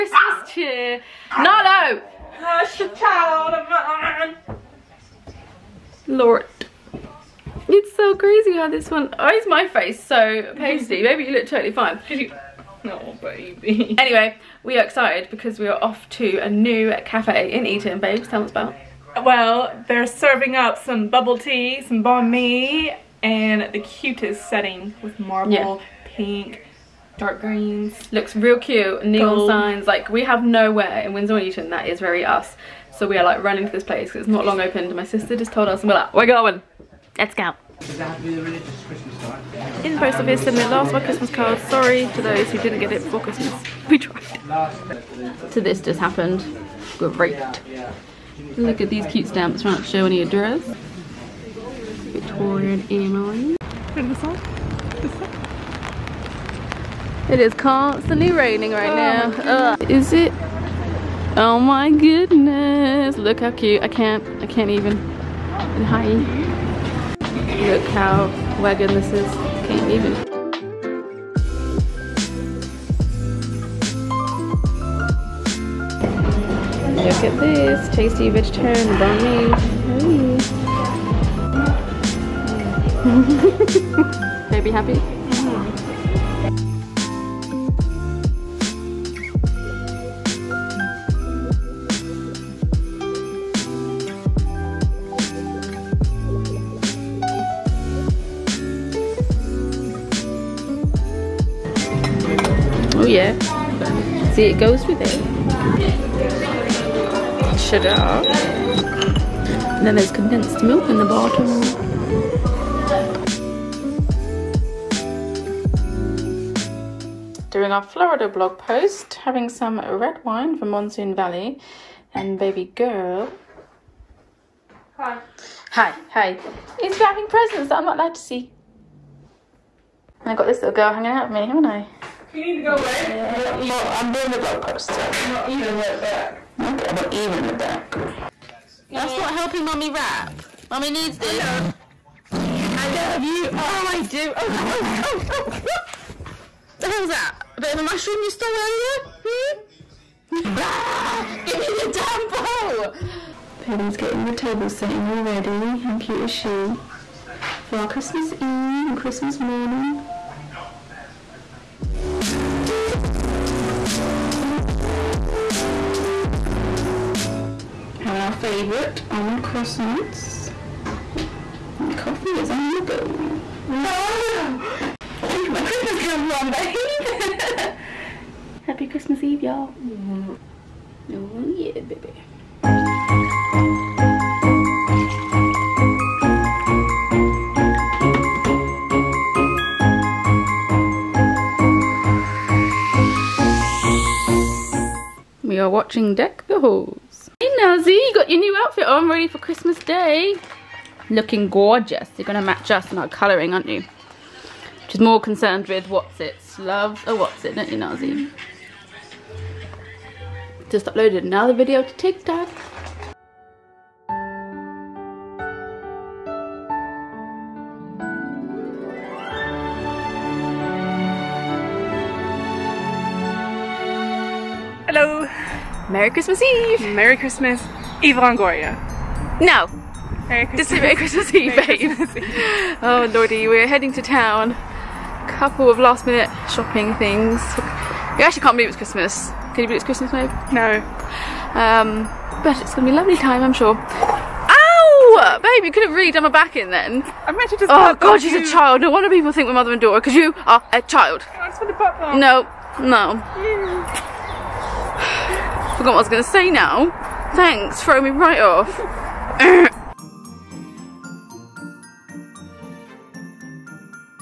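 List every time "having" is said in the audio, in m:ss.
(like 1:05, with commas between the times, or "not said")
1:59, 2:47.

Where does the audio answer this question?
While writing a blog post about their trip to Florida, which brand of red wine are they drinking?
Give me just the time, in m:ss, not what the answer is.
2:00.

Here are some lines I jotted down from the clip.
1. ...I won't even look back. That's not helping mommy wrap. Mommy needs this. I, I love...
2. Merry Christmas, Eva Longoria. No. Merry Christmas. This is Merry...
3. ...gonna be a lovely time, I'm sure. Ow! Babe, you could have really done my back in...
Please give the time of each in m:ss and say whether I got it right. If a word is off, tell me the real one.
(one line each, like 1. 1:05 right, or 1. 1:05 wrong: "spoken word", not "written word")
1. 2:16 right
2. 3:46 right
3. 4:02 right.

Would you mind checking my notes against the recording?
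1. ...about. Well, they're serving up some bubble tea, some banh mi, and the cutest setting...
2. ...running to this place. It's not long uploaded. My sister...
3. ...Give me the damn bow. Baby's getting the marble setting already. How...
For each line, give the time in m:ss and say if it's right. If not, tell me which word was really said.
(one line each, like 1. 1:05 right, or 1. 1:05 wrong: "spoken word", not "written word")
1. 0:18 right
2. 0:33 wrong: "opened", not "uploaded"
3. 2:31 wrong: "table", not "marble".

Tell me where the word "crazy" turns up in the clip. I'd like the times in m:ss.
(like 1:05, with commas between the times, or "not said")
0:08.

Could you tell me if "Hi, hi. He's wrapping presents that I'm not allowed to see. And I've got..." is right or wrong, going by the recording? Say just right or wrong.
right.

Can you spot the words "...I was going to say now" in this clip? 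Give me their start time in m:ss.
4:16.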